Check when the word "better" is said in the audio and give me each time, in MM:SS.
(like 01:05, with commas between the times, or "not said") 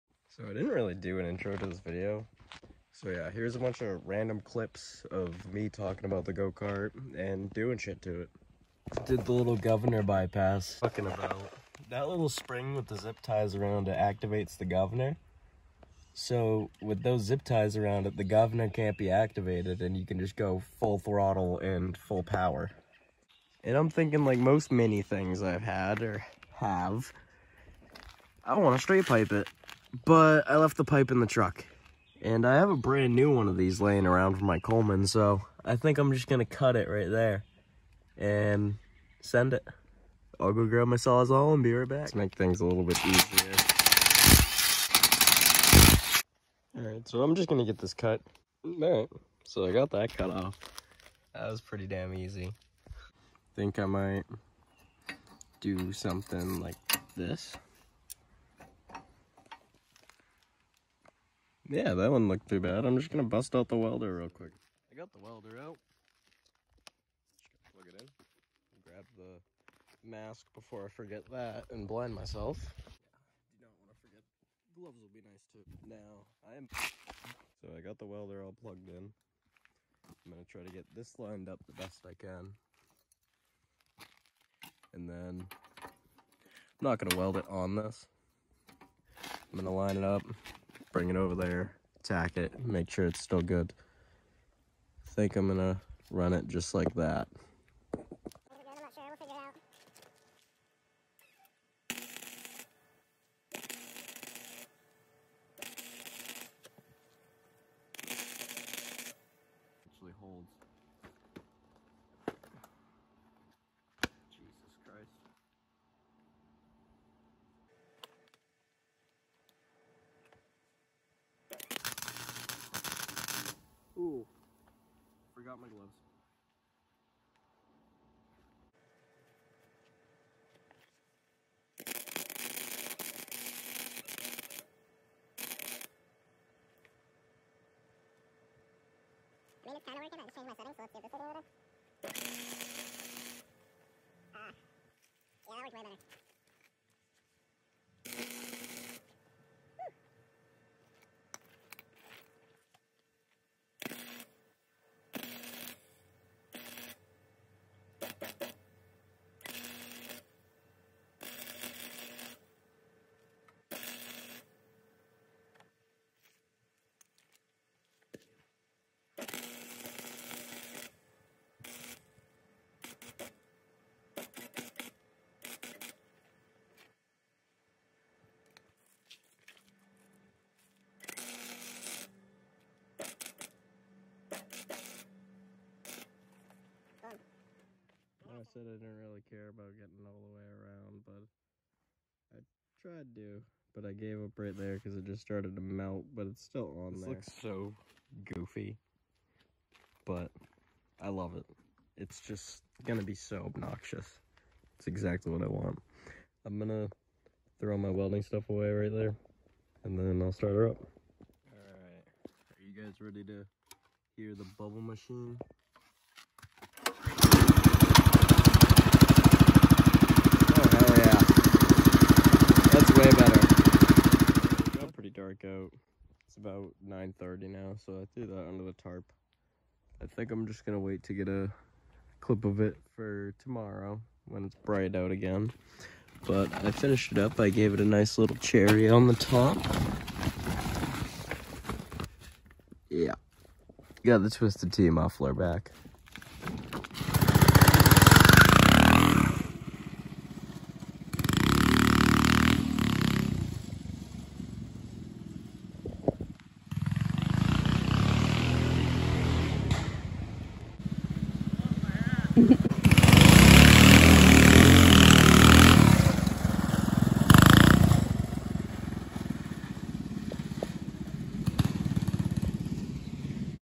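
02:25, 03:43.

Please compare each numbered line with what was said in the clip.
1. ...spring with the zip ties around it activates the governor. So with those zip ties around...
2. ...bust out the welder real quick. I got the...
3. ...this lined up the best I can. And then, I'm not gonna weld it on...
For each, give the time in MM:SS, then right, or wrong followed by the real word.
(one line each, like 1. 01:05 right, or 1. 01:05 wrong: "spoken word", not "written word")
1. 00:12 right
2. 01:03 right
3. 01:20 right.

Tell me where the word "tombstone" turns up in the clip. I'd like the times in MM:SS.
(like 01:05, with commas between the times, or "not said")
not said.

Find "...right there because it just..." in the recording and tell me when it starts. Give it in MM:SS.
03:14.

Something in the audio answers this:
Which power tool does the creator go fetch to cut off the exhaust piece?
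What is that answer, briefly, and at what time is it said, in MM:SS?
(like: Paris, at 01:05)
Sawzall, at 00:40.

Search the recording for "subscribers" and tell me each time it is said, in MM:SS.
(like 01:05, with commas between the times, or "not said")
not said.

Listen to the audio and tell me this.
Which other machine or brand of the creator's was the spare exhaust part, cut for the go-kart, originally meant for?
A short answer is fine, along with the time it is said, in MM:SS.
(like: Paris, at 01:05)
Coleman, at 00:34.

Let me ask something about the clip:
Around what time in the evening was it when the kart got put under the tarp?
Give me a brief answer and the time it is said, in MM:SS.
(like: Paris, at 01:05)
9:30, at 03:46.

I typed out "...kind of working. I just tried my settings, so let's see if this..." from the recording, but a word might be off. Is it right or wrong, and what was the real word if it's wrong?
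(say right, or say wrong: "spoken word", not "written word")
wrong: "changed", not "tried".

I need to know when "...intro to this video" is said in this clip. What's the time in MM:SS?
00:01.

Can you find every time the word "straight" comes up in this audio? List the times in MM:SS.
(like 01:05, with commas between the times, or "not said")
00:28.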